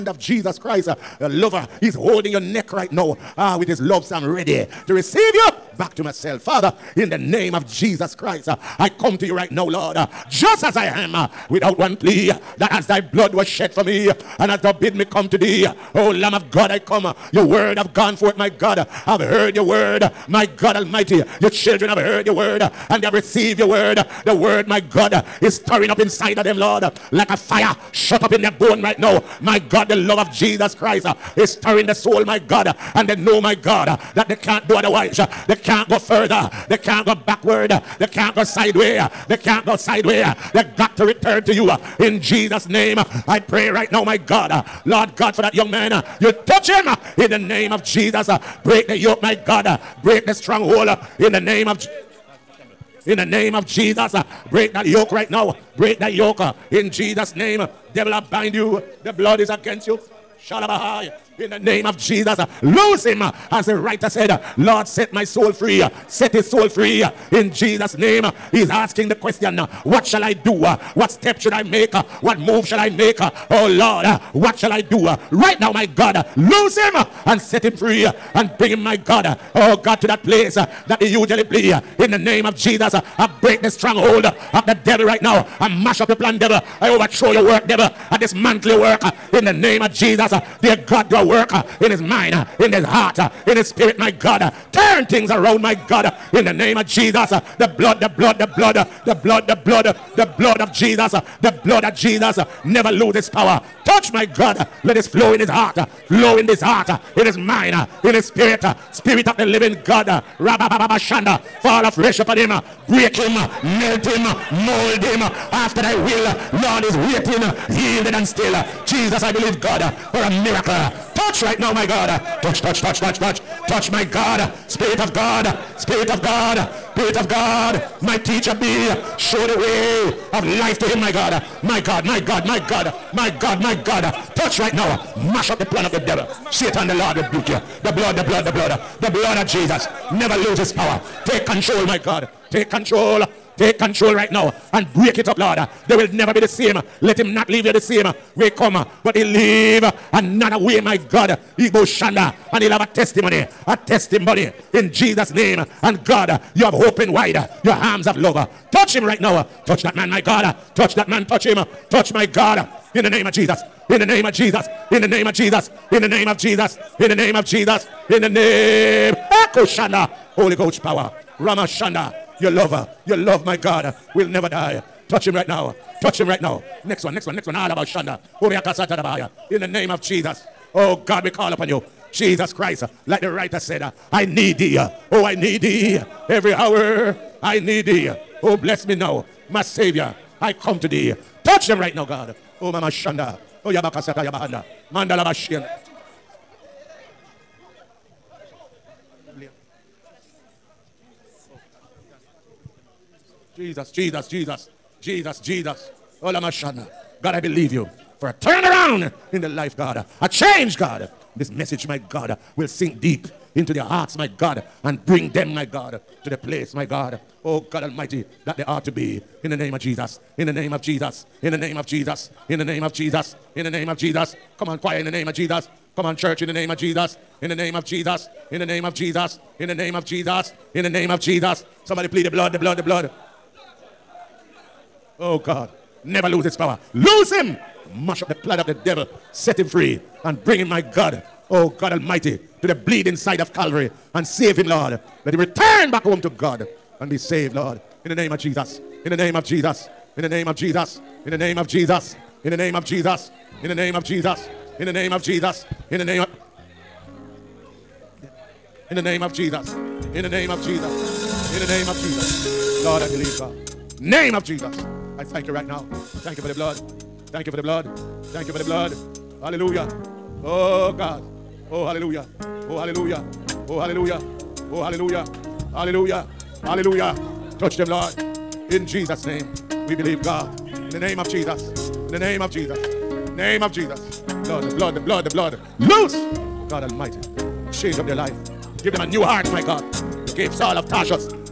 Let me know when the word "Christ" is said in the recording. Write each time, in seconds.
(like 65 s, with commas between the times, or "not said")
0 s, 8 s, 30 s, 182 s.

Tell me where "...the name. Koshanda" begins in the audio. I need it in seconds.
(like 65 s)
168 s.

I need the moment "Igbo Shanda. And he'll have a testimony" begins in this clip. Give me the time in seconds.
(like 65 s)
151 s.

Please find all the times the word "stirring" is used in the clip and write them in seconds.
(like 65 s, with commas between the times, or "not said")
25 s, 31 s.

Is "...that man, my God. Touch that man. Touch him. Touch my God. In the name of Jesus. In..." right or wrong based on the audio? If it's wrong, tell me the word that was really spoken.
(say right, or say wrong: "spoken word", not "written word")
right.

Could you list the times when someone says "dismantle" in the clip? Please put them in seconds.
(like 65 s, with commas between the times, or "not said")
88 s.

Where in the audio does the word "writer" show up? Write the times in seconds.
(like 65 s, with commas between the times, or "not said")
63 s, 183 s.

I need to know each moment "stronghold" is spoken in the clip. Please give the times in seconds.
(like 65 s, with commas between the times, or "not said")
50 s, 83 s.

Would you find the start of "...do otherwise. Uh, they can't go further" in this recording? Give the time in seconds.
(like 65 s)
34 s.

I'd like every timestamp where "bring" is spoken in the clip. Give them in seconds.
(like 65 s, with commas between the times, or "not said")
78 s, 215 s, 240 s.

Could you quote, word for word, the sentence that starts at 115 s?
After thy will, Lord is waiting, yielded and still.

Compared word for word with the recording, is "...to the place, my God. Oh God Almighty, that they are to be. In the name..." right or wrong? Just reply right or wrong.
right.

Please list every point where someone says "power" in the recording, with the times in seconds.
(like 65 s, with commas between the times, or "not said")
103 s, 140 s, 170 s, 236 s.